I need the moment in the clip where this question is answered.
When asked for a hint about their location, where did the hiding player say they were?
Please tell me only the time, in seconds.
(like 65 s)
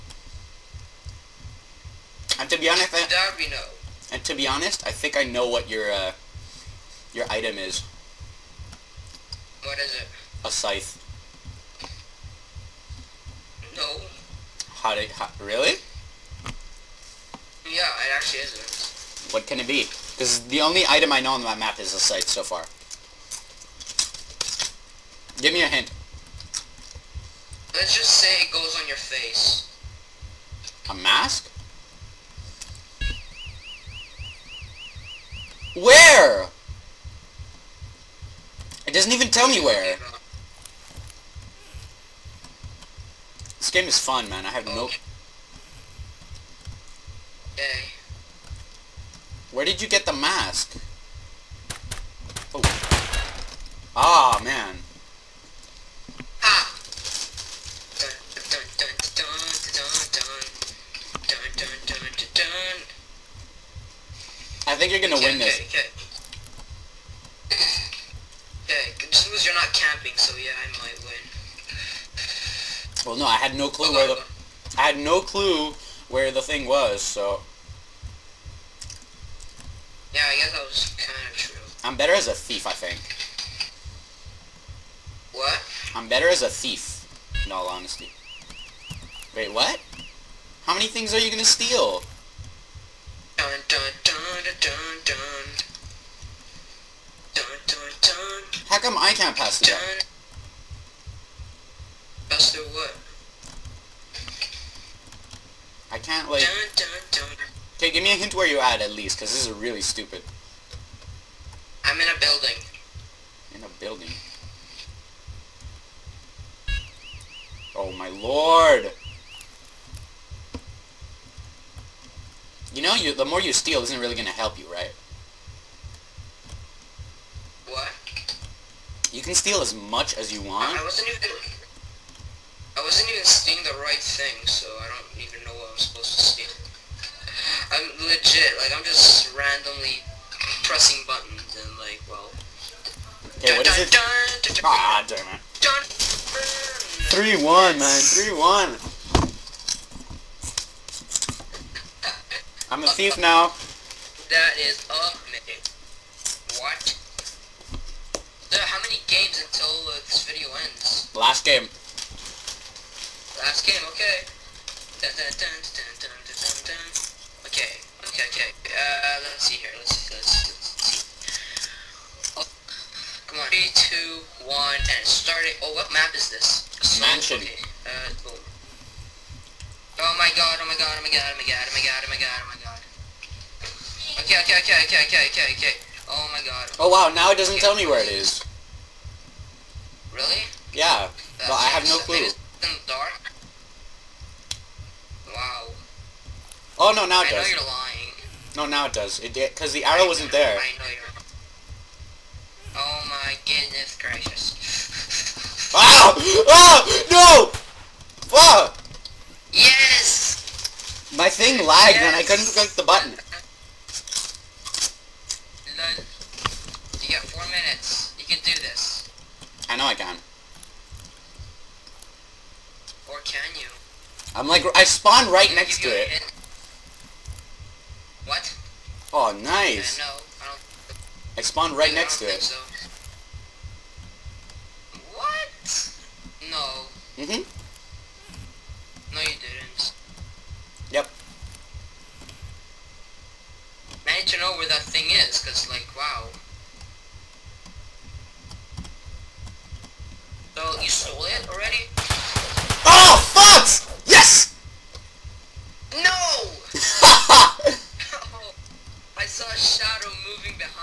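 111 s.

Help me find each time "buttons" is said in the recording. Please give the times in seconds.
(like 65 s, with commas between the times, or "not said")
141 s, 212 s.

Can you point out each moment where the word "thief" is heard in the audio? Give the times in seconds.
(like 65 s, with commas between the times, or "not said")
82 s, 86 s, 152 s.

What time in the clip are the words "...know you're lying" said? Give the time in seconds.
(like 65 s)
197 s.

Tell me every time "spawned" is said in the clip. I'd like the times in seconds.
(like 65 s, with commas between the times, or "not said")
224 s, 231 s.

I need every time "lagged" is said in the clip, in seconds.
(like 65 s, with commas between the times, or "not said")
211 s.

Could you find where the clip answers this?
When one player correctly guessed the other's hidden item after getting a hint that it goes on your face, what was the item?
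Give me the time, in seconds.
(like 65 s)
30 s.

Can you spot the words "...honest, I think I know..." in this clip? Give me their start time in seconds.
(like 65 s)
4 s.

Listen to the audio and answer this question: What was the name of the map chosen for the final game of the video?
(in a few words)
Mansion.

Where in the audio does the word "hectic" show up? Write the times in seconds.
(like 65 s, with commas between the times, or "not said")
not said.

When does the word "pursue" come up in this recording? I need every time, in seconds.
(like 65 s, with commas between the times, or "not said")
not said.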